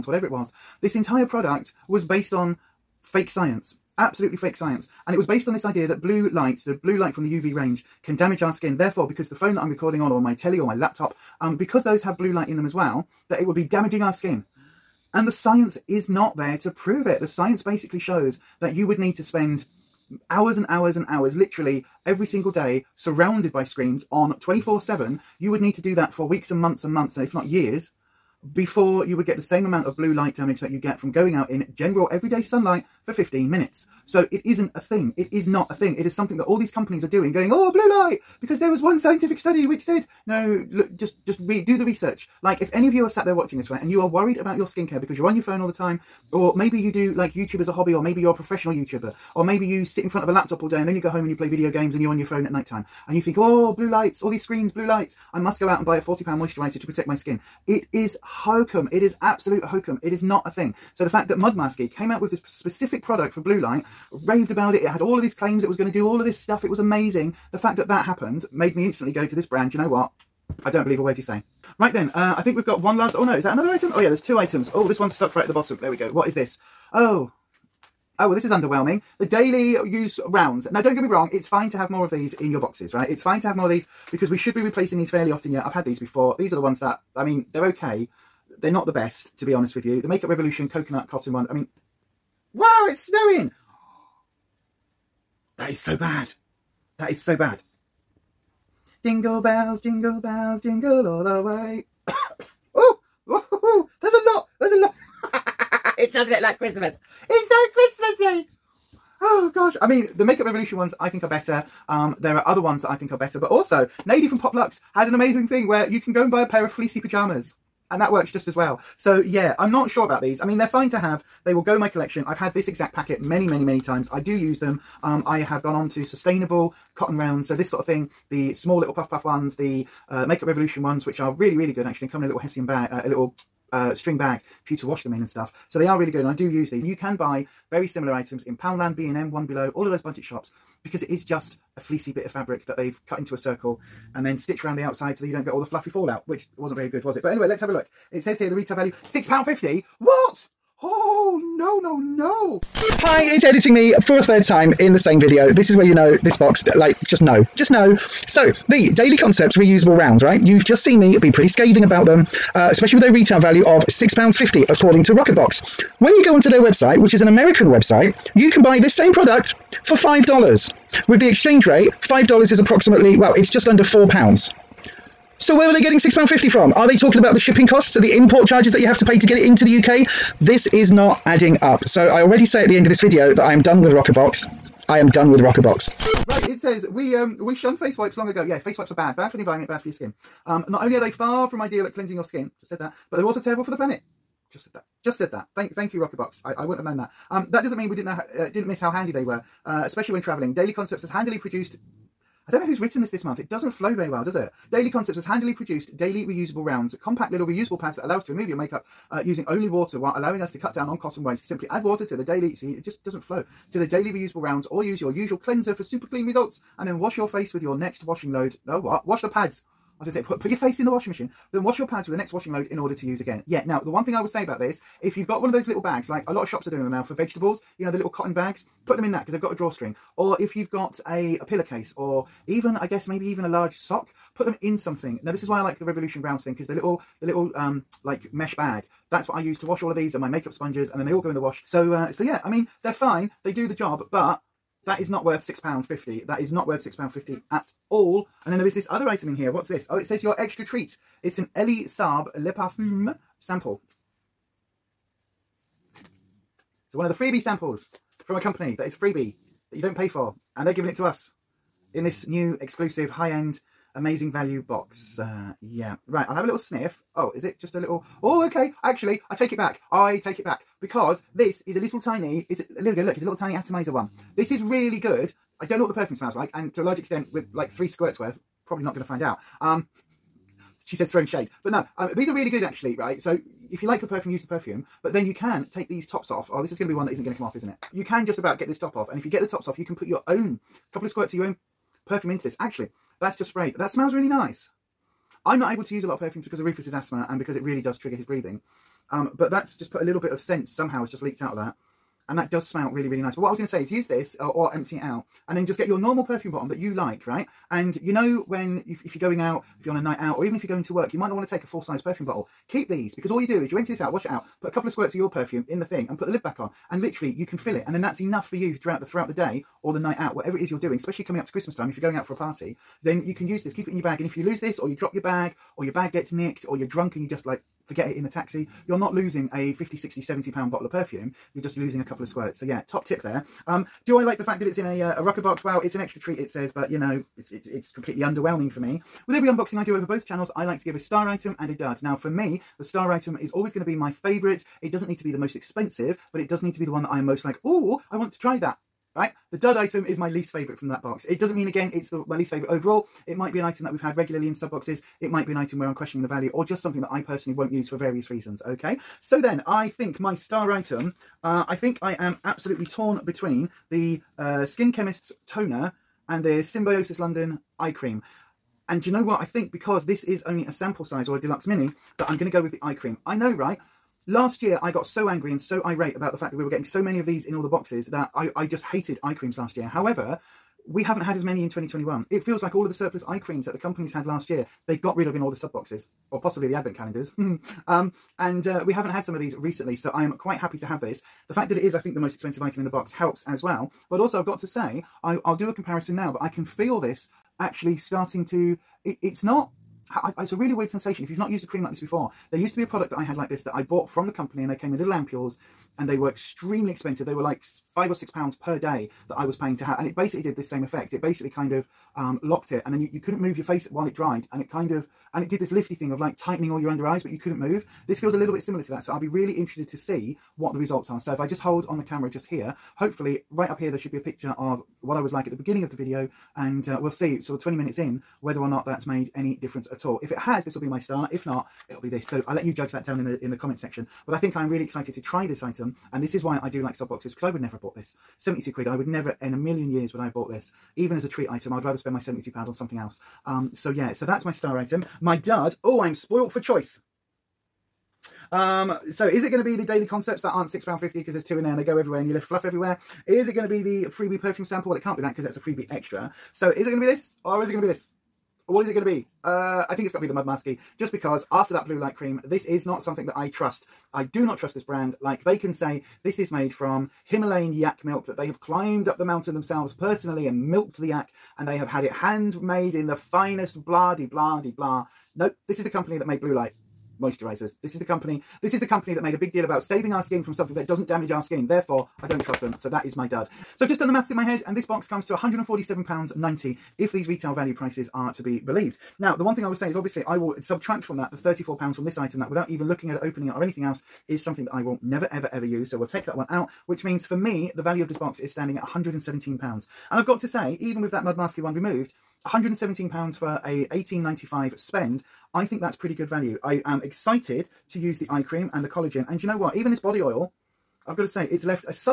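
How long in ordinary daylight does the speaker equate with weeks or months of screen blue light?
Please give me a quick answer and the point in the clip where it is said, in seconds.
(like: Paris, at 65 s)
15 minutes, at 33 s.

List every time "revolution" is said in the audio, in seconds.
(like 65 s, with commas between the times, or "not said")
90 s, 110 s, 130 s, 235 s.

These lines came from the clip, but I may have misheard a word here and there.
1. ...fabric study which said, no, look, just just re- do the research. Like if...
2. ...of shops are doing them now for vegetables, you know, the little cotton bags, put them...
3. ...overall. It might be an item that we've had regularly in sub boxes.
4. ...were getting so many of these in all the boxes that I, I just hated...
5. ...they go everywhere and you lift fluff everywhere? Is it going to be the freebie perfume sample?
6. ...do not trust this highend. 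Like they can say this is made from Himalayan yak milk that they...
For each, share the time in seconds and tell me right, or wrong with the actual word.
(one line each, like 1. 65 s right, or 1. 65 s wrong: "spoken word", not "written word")
1. 38 s wrong: "scientific", not "fabric"
2. 226 s right
3. 352 s right
4. 376 s right
5. 451 s right
6. 464 s wrong: "brand", not "highend".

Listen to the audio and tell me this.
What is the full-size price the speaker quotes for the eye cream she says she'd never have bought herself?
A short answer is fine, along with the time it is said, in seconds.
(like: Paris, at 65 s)
£72, at 438 s.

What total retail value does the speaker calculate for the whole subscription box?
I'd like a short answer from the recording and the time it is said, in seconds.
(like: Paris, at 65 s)
£147.90, at 485 s.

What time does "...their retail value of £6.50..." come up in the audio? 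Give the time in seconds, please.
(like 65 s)
163 s.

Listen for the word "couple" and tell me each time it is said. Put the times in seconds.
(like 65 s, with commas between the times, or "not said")
290 s, 314 s, 332 s.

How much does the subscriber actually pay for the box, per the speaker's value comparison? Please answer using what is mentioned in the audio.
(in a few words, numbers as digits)
£18.95.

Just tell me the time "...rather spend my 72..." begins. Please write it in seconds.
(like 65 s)
441 s.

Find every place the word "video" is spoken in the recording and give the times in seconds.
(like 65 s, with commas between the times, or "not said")
51 s, 155 s, 182 s, 425 s.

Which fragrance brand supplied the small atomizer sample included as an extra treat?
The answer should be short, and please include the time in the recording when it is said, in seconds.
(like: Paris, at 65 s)
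Elie Saab, at 251 s.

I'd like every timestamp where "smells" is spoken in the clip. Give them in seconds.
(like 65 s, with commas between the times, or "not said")
276 s, 293 s, 302 s.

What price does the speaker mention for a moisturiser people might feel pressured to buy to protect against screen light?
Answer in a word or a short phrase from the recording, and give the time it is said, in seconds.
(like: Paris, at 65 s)
£40, at 55 s.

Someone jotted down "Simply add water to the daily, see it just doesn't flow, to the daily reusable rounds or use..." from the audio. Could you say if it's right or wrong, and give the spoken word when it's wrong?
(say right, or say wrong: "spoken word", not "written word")
right.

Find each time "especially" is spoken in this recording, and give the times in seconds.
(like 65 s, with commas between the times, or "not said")
162 s, 199 s, 320 s.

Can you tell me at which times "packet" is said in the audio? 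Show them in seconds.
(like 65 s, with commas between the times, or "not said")
122 s.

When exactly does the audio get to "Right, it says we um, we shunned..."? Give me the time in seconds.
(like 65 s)
186 s.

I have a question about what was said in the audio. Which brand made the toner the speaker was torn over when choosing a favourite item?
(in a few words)
Skin Chemist.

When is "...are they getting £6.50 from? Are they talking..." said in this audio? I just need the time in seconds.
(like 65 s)
175 s.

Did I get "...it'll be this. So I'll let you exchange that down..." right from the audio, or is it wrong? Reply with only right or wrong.
wrong.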